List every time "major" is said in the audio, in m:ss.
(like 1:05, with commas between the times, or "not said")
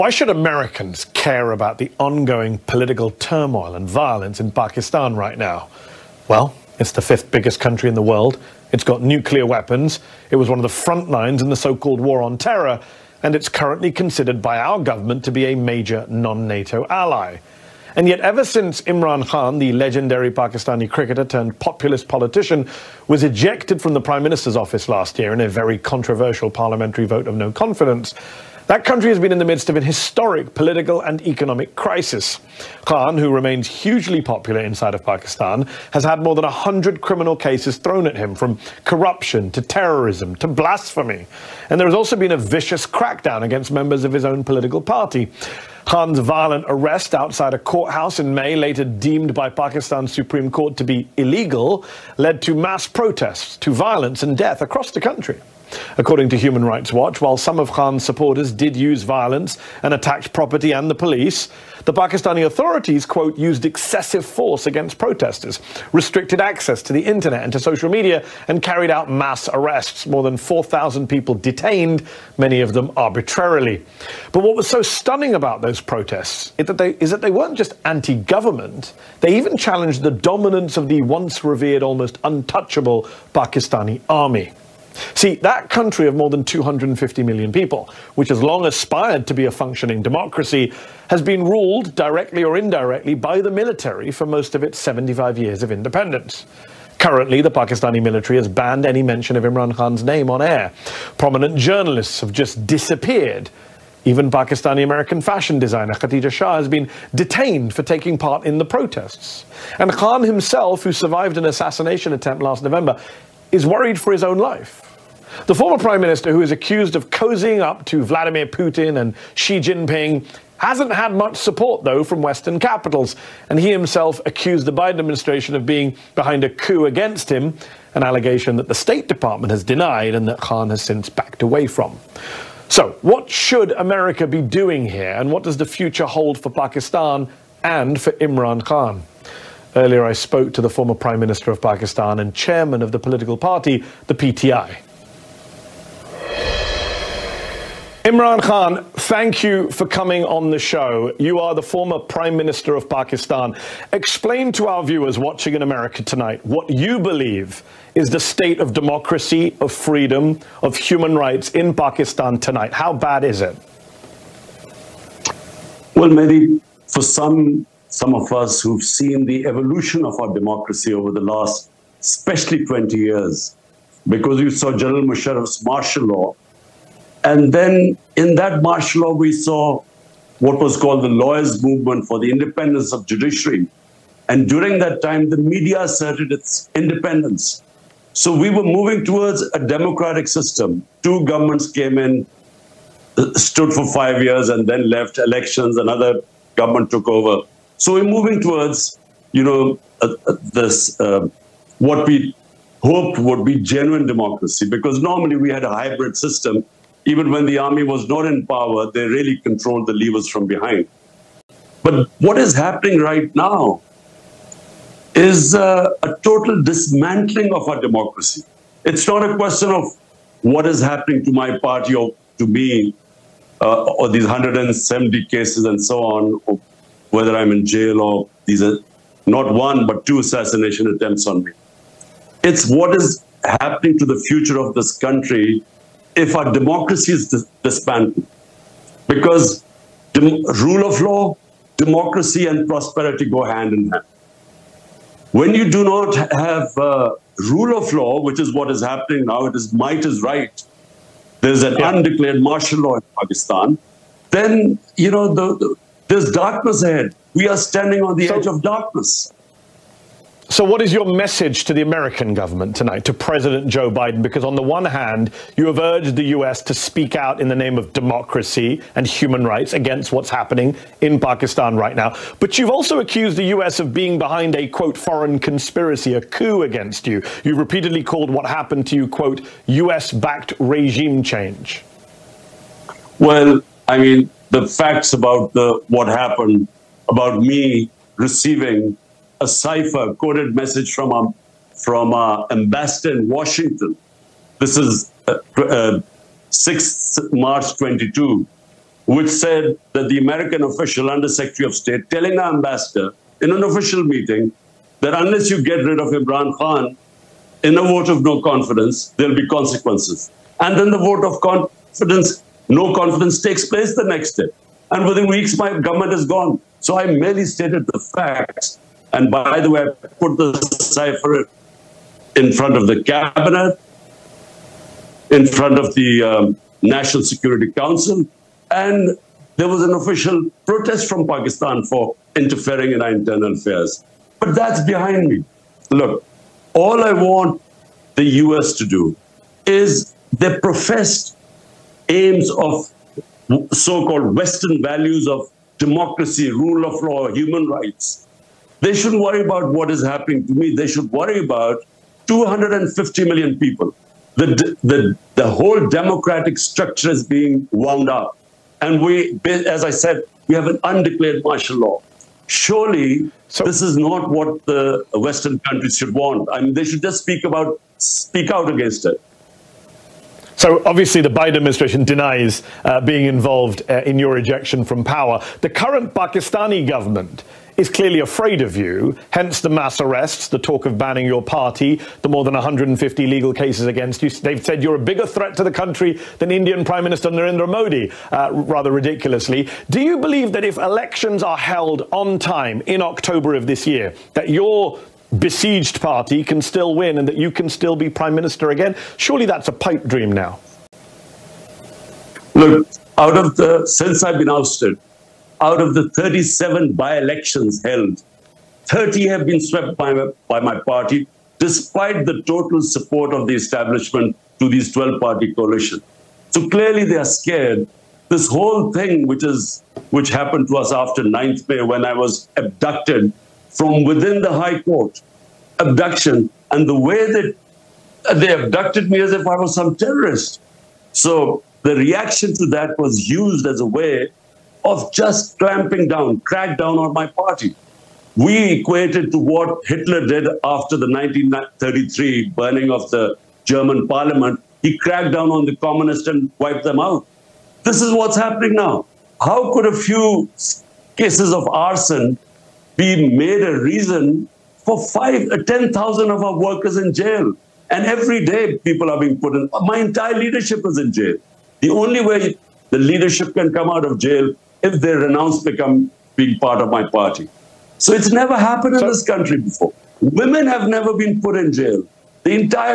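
0:15.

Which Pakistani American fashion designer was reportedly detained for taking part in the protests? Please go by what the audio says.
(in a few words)
Khadija Shah.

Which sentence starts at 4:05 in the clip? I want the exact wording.
When you do not have uh, rule of law, which is what is happening now, it is might is right.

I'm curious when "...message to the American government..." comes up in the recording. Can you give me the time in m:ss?
4:21.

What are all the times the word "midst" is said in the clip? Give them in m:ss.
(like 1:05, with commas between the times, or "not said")
0:29.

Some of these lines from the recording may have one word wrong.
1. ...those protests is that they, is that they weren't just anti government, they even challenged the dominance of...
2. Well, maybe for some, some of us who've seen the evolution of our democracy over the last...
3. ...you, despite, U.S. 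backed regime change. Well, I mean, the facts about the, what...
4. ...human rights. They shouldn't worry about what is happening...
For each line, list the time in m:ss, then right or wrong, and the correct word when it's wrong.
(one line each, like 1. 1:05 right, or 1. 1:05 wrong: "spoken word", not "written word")
1. 1:15 right
2. 2:45 right
3. 4:38 wrong: "quote", not "despite"
4. 5:47 right.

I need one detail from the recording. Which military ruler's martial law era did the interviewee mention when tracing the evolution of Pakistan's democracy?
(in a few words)
General Musharraf.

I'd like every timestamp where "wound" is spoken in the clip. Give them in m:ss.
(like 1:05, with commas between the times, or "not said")
5:57.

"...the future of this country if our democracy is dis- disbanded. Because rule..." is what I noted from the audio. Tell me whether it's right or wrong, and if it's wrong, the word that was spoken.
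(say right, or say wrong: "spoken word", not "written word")
right.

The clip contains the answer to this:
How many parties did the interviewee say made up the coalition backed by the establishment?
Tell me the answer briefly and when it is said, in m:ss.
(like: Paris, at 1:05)
12, at 6:54.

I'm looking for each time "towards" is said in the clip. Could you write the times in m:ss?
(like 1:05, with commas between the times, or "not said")
3:09, 3:18.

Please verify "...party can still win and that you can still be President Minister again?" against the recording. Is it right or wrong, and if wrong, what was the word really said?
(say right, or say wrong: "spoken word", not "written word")
wrong: "Prime", not "President".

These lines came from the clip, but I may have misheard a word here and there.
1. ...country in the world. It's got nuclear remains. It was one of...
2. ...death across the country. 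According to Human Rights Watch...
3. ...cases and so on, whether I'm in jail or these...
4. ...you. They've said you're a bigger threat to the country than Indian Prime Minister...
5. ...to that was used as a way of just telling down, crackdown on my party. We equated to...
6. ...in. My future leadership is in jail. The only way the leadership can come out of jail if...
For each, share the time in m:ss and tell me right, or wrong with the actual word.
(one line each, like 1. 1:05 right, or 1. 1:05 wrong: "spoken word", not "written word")
1. 0:07 wrong: "weapons", not "remains"
2. 0:54 right
3. 3:45 right
4. 6:24 right
5. 7:12 wrong: "clamping", not "telling"
6. 7:39 wrong: "entire", not "future".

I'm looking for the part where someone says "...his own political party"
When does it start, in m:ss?
0:44.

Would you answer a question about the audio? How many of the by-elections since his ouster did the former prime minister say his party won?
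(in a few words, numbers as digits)
30.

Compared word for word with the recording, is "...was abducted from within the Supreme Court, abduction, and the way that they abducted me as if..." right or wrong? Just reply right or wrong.
wrong.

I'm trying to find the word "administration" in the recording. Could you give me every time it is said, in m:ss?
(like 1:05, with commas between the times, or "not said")
2:04, 6:11.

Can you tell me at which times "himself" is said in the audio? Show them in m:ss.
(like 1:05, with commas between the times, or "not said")
1:50, 2:03.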